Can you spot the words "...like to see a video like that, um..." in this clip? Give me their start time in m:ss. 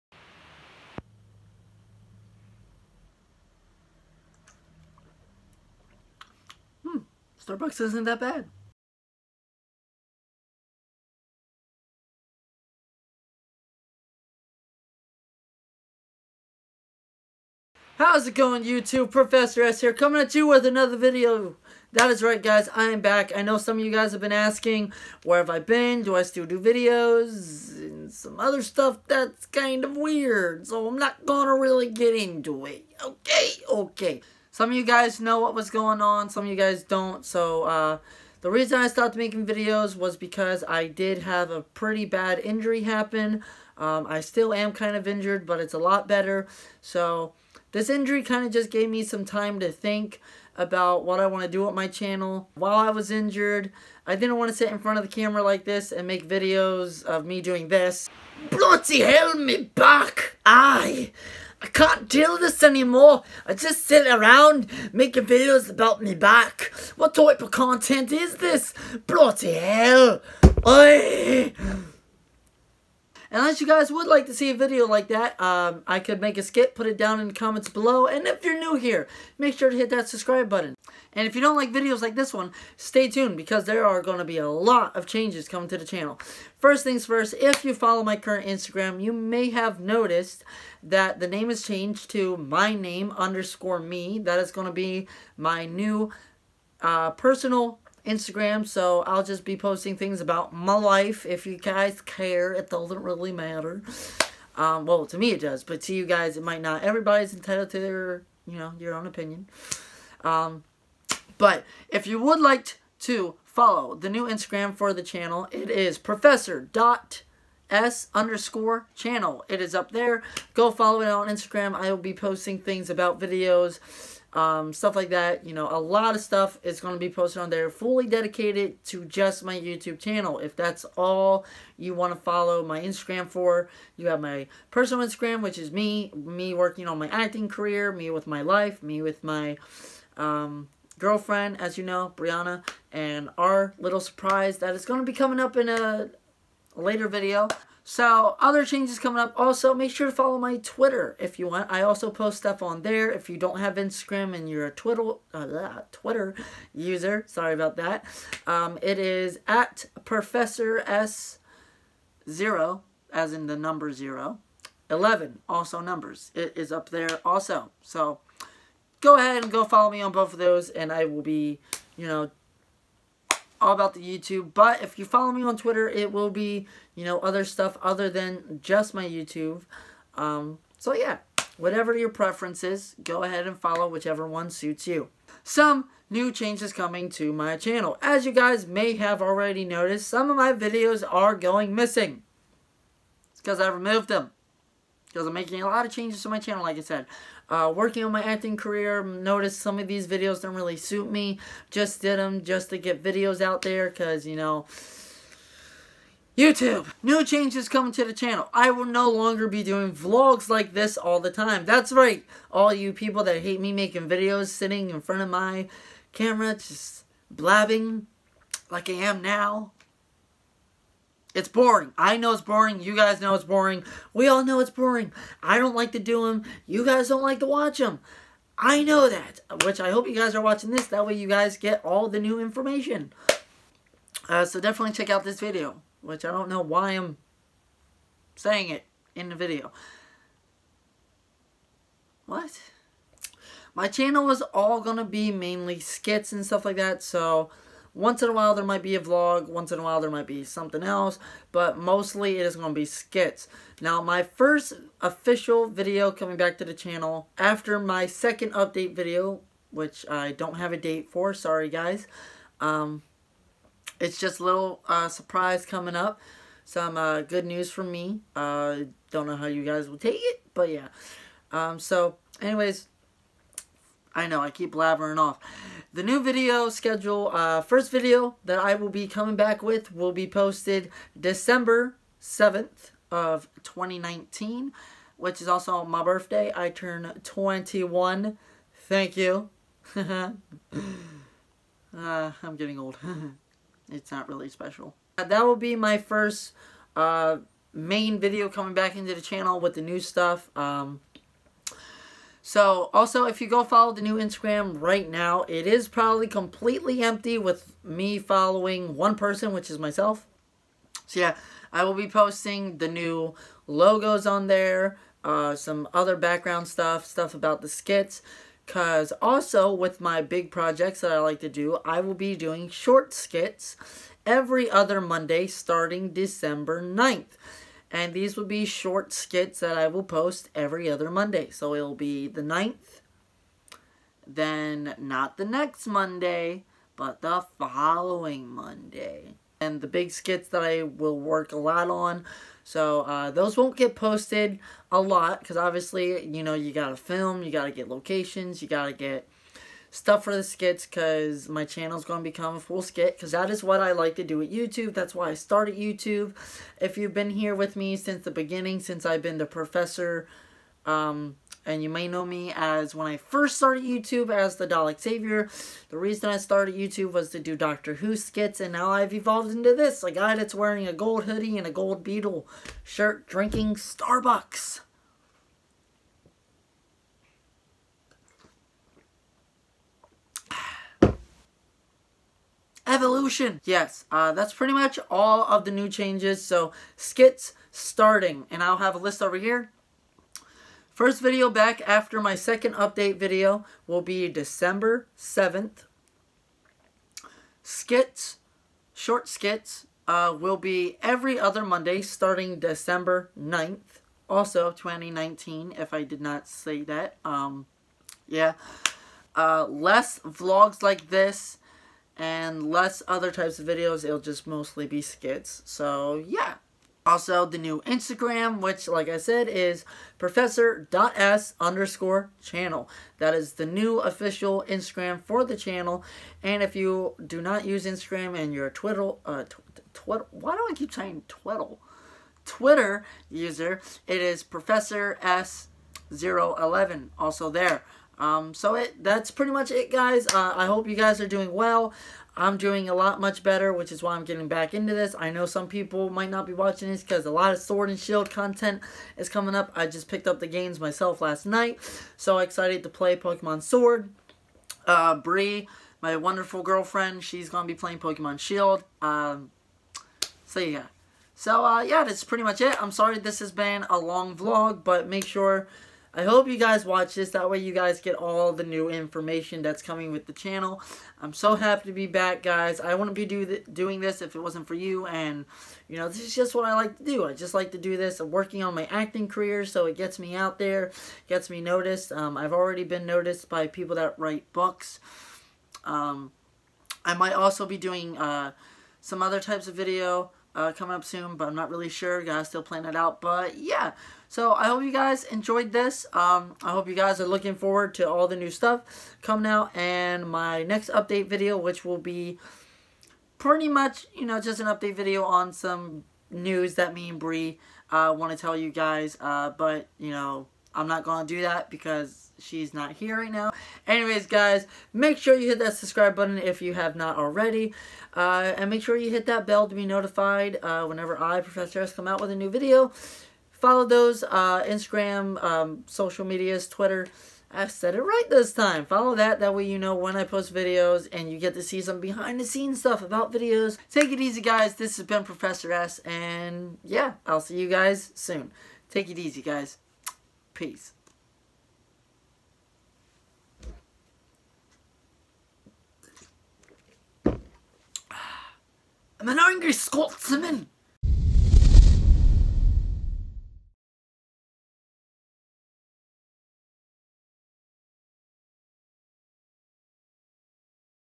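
1:14.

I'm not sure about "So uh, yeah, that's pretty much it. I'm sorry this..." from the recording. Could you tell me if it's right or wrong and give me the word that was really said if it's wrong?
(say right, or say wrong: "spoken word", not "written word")
right.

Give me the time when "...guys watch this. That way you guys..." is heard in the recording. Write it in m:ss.
7:46.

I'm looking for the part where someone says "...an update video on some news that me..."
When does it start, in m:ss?
8:24.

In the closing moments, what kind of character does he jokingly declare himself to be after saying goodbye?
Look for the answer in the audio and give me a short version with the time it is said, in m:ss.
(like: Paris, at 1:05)
angry Scotsman, at 9:09.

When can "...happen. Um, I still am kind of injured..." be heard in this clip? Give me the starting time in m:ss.
0:42.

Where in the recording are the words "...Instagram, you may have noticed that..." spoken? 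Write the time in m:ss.
1:28.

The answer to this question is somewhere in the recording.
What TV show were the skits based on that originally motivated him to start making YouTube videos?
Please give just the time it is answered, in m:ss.
6:07.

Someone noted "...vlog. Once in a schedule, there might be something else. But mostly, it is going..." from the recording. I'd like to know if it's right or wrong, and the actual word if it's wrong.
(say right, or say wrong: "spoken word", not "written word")
wrong: "while", not "schedule".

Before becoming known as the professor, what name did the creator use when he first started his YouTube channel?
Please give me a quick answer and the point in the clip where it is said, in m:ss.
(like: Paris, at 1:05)
Dalek Savior, at 6:04.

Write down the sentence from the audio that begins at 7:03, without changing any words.
That is the new official Instagram for the channel.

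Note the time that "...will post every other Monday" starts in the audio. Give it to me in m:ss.
5:29.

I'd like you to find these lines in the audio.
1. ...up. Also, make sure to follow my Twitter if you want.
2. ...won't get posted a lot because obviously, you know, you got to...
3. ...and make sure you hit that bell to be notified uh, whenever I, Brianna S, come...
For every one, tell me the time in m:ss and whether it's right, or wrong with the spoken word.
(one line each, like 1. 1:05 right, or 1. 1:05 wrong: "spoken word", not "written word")
1. 2:29 right
2. 5:43 right
3. 8:38 wrong: "Professor", not "Brianna".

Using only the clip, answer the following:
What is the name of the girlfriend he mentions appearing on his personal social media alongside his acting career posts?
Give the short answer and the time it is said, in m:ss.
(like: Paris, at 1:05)
Brianna, at 2:22.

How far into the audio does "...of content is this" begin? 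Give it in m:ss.
1:07.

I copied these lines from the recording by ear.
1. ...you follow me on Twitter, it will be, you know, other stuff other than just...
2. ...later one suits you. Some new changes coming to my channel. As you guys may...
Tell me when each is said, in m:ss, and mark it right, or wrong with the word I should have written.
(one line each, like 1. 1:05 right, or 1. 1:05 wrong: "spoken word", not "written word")
1. 2:54 right
2. 3:03 wrong: "whichever", not "later".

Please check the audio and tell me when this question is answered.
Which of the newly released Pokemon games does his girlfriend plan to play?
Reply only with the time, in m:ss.
7:37.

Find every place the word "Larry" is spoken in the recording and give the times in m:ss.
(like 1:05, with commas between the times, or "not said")
not said.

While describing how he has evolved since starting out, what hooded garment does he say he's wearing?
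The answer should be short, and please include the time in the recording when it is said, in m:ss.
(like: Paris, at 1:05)
gold hoodie, at 6:10.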